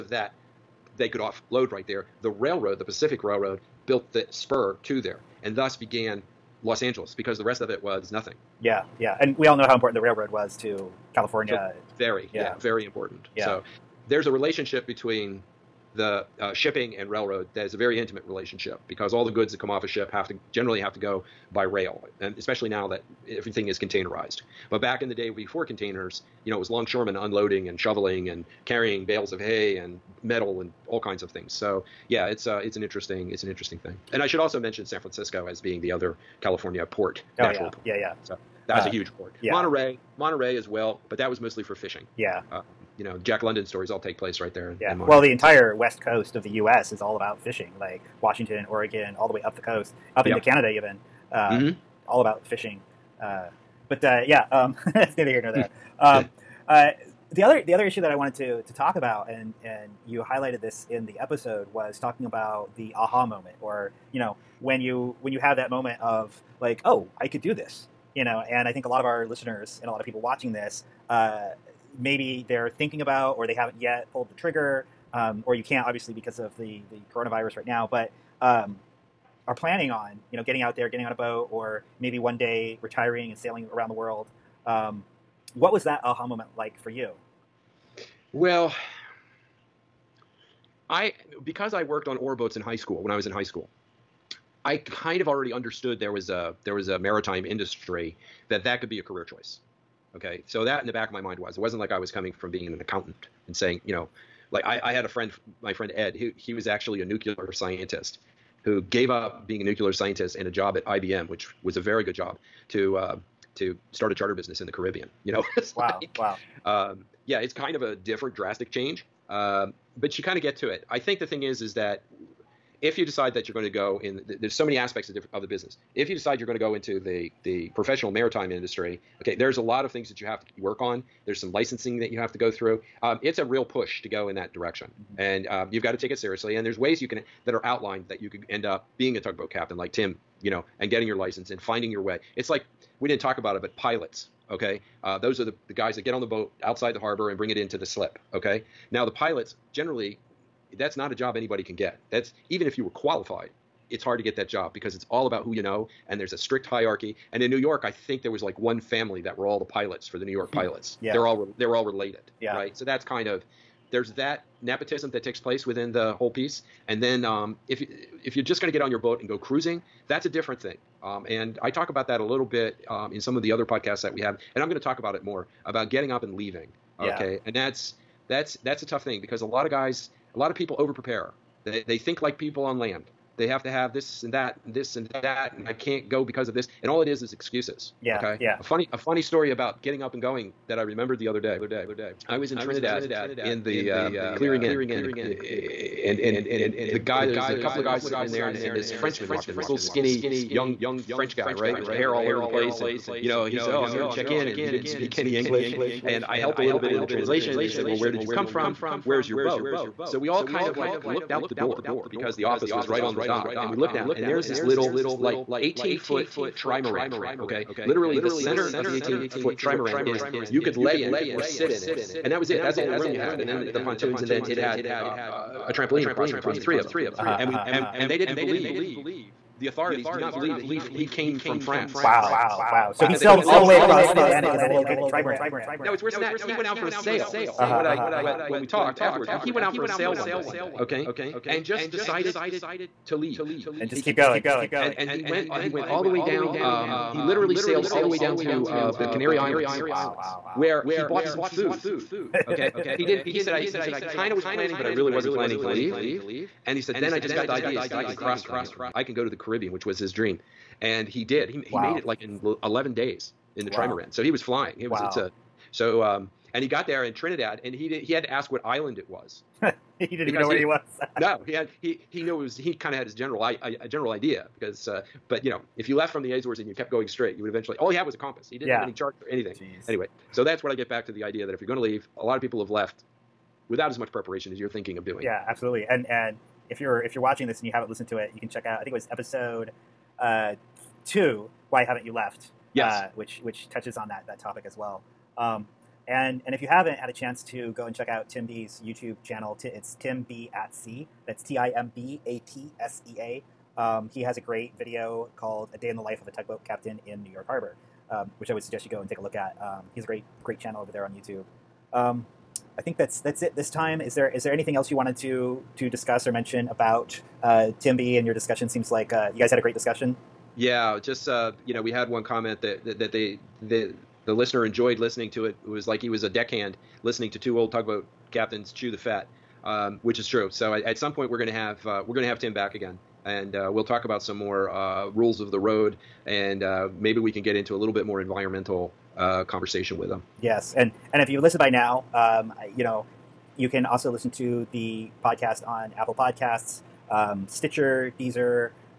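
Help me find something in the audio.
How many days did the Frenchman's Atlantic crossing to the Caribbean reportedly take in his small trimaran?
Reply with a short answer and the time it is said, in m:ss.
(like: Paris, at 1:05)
11, at 4:22.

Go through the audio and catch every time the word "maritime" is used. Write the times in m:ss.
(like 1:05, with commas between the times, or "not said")
1:36, 2:08.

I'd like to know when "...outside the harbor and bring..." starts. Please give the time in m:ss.
2:26.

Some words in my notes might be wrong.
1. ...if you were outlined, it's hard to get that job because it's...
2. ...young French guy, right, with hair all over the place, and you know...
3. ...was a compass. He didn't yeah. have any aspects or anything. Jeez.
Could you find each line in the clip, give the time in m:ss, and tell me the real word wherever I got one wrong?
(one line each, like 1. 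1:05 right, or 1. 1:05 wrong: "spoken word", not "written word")
1. 2:32 wrong: "qualified", not "outlined"
2. 3:20 right
3. 4:38 wrong: "charts", not "aspects".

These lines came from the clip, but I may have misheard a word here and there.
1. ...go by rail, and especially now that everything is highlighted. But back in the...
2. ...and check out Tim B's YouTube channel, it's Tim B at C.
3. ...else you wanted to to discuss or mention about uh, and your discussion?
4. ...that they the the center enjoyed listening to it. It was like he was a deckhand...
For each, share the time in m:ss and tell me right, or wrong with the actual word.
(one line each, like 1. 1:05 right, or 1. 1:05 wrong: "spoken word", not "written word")
1. 0:20 wrong: "containerized", not "highlighted"
2. 4:57 right
3. 5:14 right
4. 5:22 wrong: "listener", not "center".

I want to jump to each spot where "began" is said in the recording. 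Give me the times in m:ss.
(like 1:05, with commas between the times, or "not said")
0:05.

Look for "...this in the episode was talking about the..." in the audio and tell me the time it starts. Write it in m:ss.
1:00.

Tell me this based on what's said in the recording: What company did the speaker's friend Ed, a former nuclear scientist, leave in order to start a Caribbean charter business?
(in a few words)
IBM.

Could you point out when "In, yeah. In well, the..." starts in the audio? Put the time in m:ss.
0:44.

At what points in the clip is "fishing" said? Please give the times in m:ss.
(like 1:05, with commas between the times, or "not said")
0:41, 0:47, 0:52.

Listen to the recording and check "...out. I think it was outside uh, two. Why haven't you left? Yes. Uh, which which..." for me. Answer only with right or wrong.
wrong.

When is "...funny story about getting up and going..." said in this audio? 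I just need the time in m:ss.
3:08.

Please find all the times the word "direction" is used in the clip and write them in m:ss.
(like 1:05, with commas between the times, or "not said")
2:14.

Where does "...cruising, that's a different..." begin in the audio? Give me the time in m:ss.
2:49.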